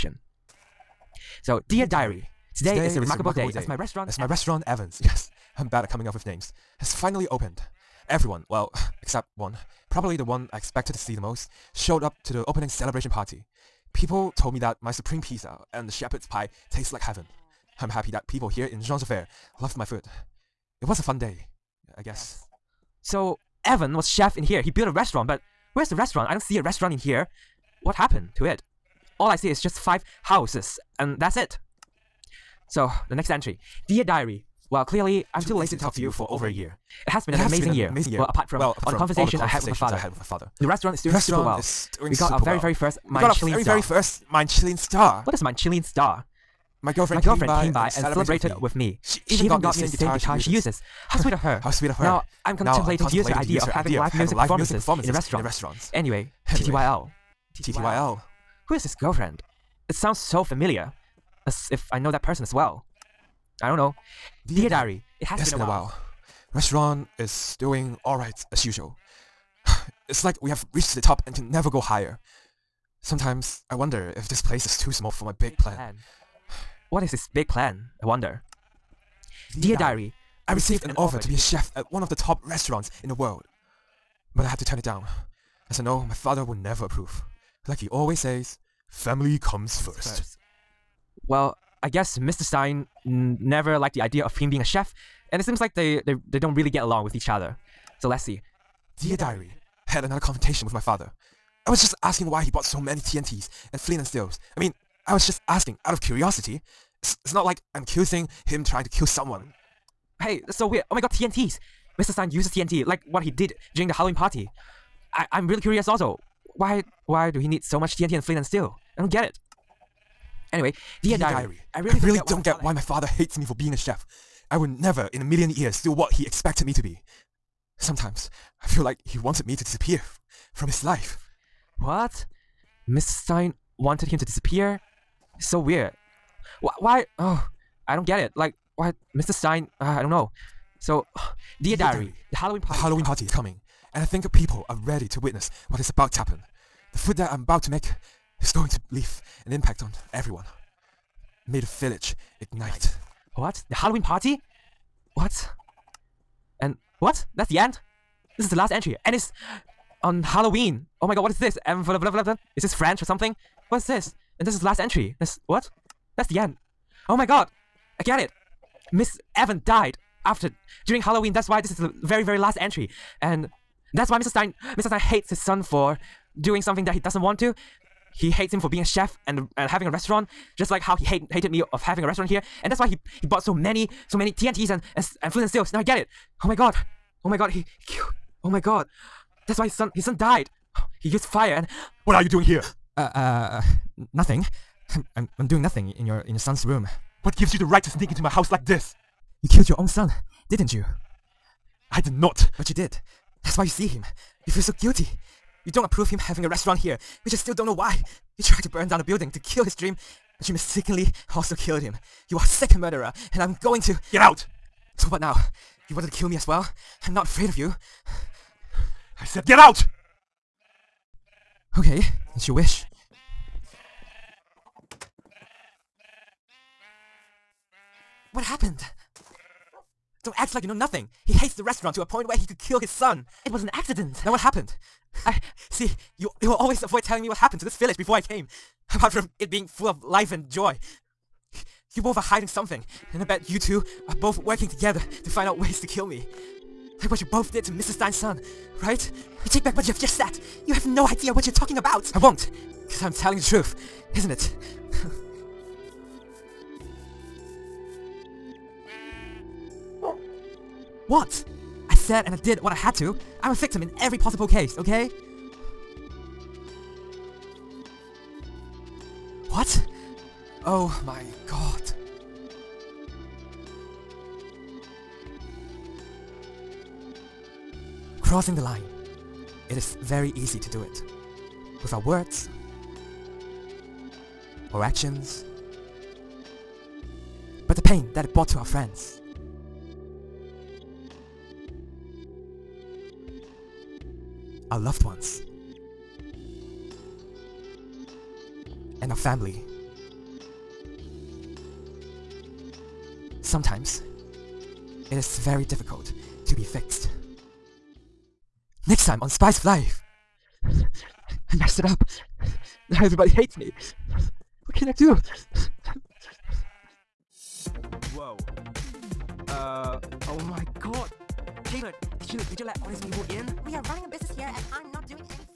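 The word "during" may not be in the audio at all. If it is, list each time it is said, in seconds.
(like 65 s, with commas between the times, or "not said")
113 s, 170 s.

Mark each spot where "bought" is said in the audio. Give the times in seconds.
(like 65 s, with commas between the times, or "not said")
102 s, 183 s.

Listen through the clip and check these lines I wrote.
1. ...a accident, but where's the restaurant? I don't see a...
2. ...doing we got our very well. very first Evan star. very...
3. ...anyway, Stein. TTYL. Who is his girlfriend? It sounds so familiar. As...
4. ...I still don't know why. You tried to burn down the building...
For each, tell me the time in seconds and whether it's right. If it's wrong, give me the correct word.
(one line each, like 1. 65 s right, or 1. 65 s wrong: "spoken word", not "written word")
1. 24 s wrong: "restaurant", not "accident"
2. 41 s wrong: "Manchilin", not "Evan"
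3. 56 s wrong: "TTYL", not "Stein"
4. 207 s right.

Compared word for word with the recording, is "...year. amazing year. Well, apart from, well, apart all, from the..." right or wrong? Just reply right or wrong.
right.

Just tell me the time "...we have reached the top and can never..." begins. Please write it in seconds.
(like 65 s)
70 s.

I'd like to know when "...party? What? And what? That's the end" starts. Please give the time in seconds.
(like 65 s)
154 s.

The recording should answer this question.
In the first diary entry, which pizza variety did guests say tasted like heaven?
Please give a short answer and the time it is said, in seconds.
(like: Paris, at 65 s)
Supreme, at 14 s.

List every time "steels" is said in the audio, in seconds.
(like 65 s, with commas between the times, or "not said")
104 s, 118 s, 185 s.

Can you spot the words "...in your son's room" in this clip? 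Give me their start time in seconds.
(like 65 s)
196 s.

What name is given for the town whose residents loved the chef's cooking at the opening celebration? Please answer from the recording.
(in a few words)
Jean Javert.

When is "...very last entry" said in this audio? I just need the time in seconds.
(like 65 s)
172 s.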